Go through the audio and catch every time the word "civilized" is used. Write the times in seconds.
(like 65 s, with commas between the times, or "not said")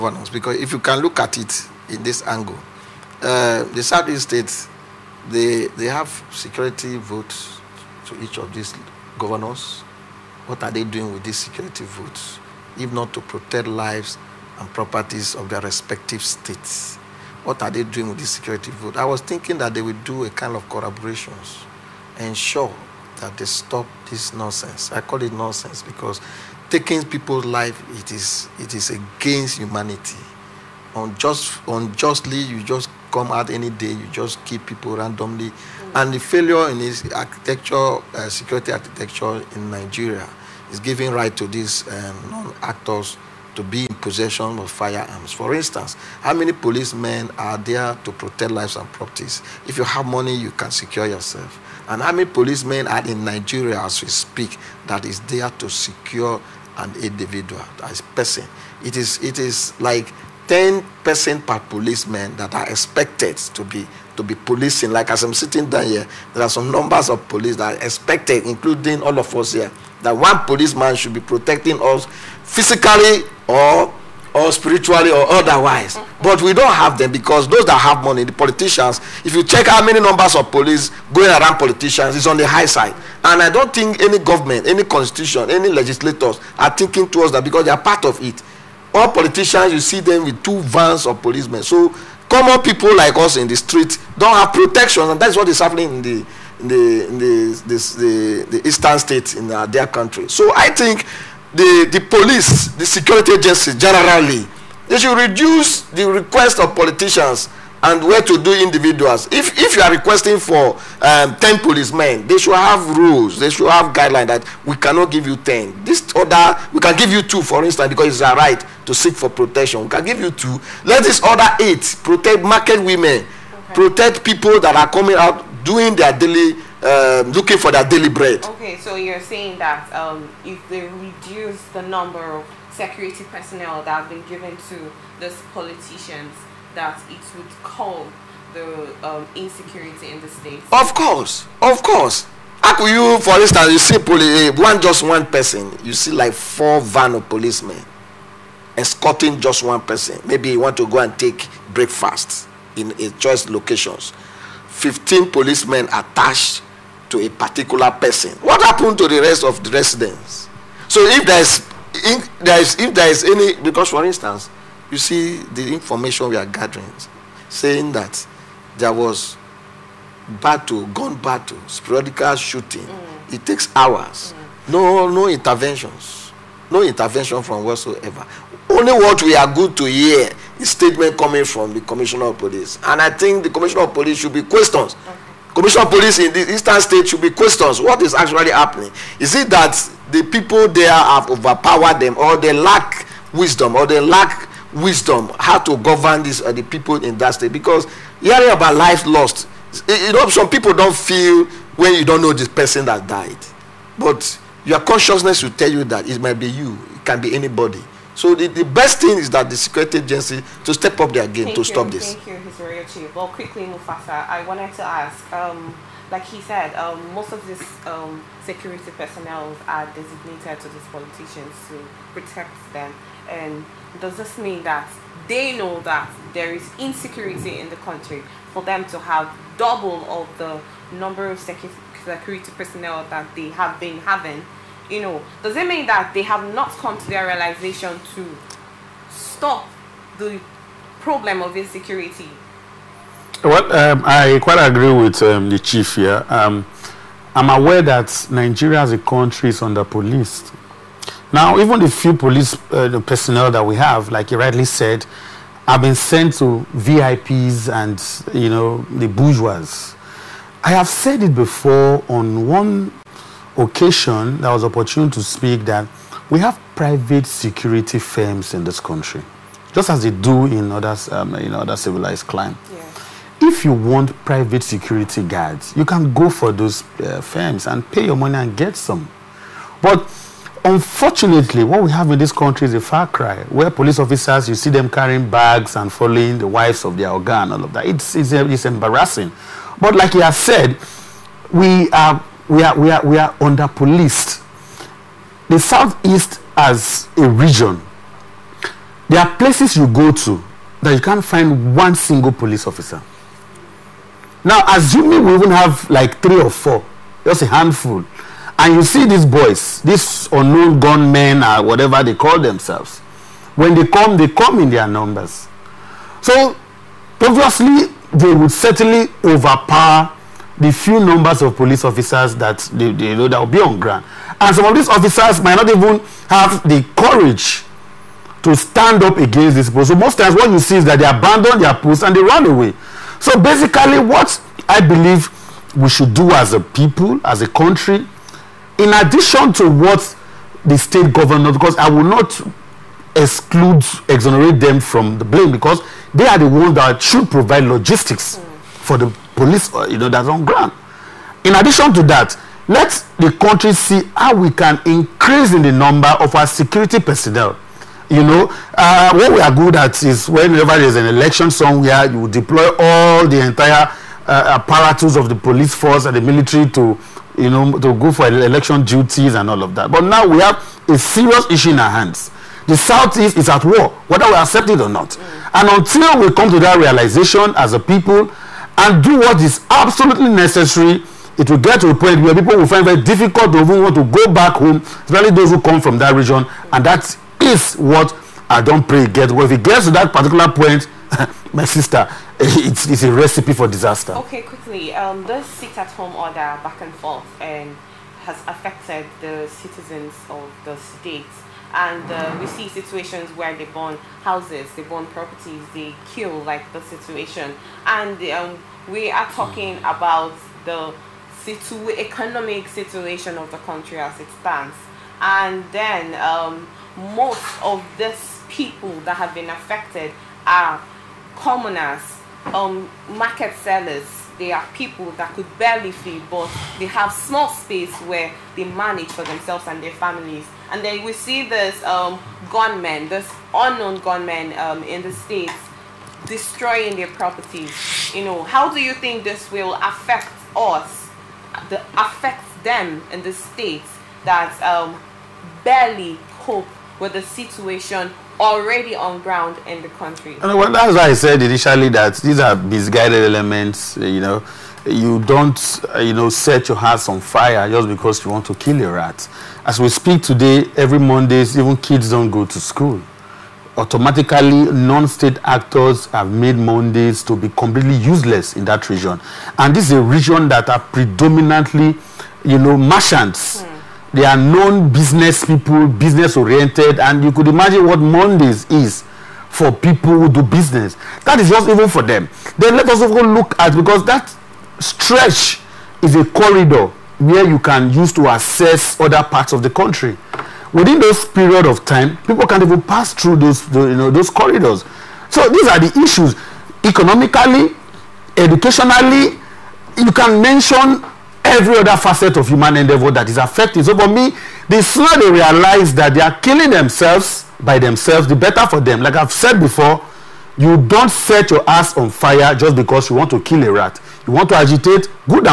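271 s.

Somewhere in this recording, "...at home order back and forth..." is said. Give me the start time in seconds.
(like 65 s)
395 s.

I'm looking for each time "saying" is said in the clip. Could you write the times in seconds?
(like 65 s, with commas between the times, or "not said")
129 s, 167 s.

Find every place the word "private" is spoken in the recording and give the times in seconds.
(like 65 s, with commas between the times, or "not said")
266 s, 274 s.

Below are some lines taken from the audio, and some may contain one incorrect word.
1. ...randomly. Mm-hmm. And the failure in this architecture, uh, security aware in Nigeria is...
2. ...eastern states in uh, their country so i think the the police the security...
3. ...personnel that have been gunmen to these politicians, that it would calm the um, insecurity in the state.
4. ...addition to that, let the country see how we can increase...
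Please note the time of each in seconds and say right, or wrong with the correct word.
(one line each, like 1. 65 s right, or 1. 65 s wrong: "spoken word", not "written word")
1. 34 s wrong: "architecture", not "aware"
2. 98 s right
3. 133 s wrong: "given", not "gunmen"
4. 351 s right.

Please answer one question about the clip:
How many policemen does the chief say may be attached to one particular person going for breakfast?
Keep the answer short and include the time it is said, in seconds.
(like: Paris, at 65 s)
15, at 154 s.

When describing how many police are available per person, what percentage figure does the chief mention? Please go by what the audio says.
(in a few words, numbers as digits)
10%.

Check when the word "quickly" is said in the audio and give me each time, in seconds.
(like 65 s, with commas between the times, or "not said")
213 s, 394 s.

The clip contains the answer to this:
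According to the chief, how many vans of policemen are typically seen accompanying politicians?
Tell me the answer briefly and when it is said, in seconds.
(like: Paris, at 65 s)
2, at 90 s.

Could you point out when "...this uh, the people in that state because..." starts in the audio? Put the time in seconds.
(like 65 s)
196 s.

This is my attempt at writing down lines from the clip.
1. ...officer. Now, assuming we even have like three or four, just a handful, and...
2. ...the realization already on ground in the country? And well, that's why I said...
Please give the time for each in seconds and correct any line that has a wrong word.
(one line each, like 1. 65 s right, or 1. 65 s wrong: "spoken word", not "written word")
1. 302 s right
2. 447 s wrong: "situation", not "realization".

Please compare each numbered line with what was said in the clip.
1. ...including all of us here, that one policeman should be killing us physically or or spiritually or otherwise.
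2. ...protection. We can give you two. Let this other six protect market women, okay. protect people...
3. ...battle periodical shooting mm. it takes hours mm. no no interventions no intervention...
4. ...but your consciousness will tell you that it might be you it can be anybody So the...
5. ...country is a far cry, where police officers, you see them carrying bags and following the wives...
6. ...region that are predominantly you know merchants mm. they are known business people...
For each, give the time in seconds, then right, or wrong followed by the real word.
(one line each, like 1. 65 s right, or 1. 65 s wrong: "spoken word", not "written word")
1. 68 s wrong: "protecting", not "killing"
2. 119 s wrong: "eight", not "six"
3. 171 s right
4. 203 s right
5. 282 s right
6. 470 s right.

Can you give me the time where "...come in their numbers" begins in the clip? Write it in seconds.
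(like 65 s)
314 s.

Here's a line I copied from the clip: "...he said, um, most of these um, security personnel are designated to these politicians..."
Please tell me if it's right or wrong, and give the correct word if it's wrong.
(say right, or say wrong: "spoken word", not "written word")
right.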